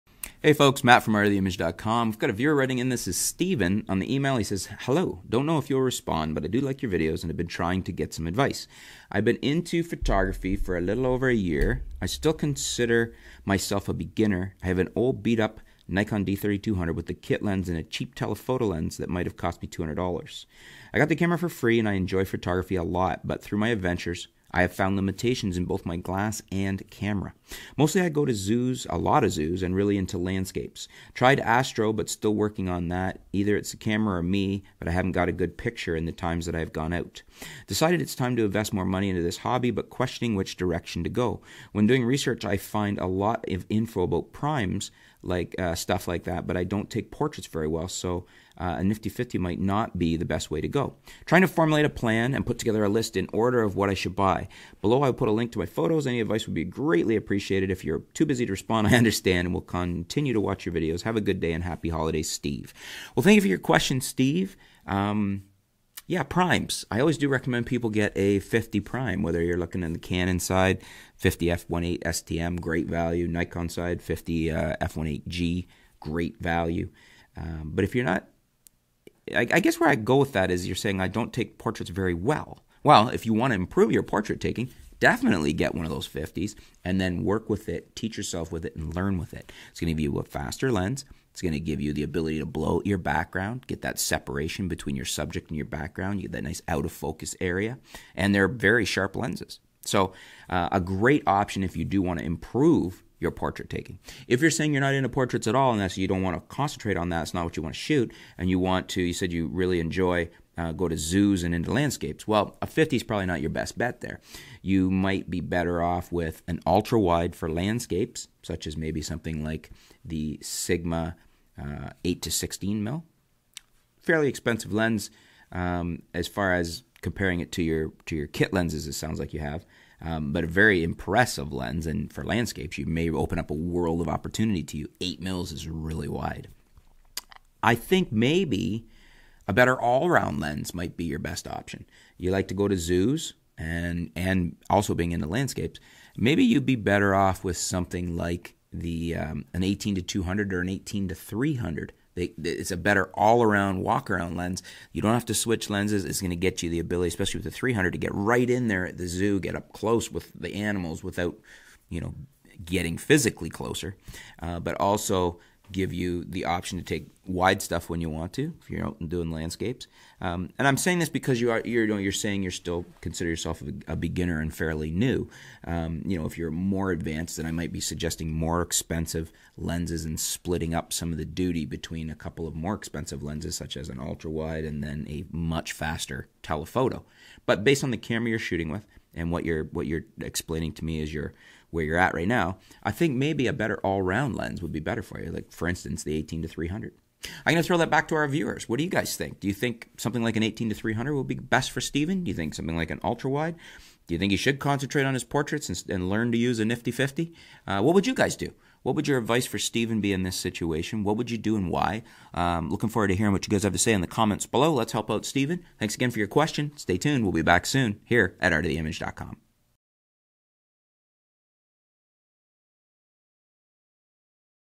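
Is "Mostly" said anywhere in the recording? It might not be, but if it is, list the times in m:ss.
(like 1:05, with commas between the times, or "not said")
0:27.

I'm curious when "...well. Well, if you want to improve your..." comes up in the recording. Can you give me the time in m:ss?
1:22.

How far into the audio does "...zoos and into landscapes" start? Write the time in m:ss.
1:50.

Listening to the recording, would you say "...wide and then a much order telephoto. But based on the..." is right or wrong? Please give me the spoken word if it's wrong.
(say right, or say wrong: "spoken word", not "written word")
wrong: "faster", not "order".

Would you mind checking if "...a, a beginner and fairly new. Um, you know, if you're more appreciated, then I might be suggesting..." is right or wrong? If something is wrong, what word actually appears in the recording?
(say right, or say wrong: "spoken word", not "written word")
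wrong: "advanced", not "appreciated".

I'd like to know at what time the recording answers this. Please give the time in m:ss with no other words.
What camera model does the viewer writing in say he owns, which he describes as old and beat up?
0:15.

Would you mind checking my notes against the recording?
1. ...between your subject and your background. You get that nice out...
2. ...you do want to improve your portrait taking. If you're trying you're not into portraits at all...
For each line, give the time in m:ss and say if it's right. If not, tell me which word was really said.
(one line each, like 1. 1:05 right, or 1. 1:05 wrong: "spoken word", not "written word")
1. 1:34 right
2. 1:41 wrong: "saying", not "trying".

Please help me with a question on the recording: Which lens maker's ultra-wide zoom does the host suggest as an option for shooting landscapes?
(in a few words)
Sigma.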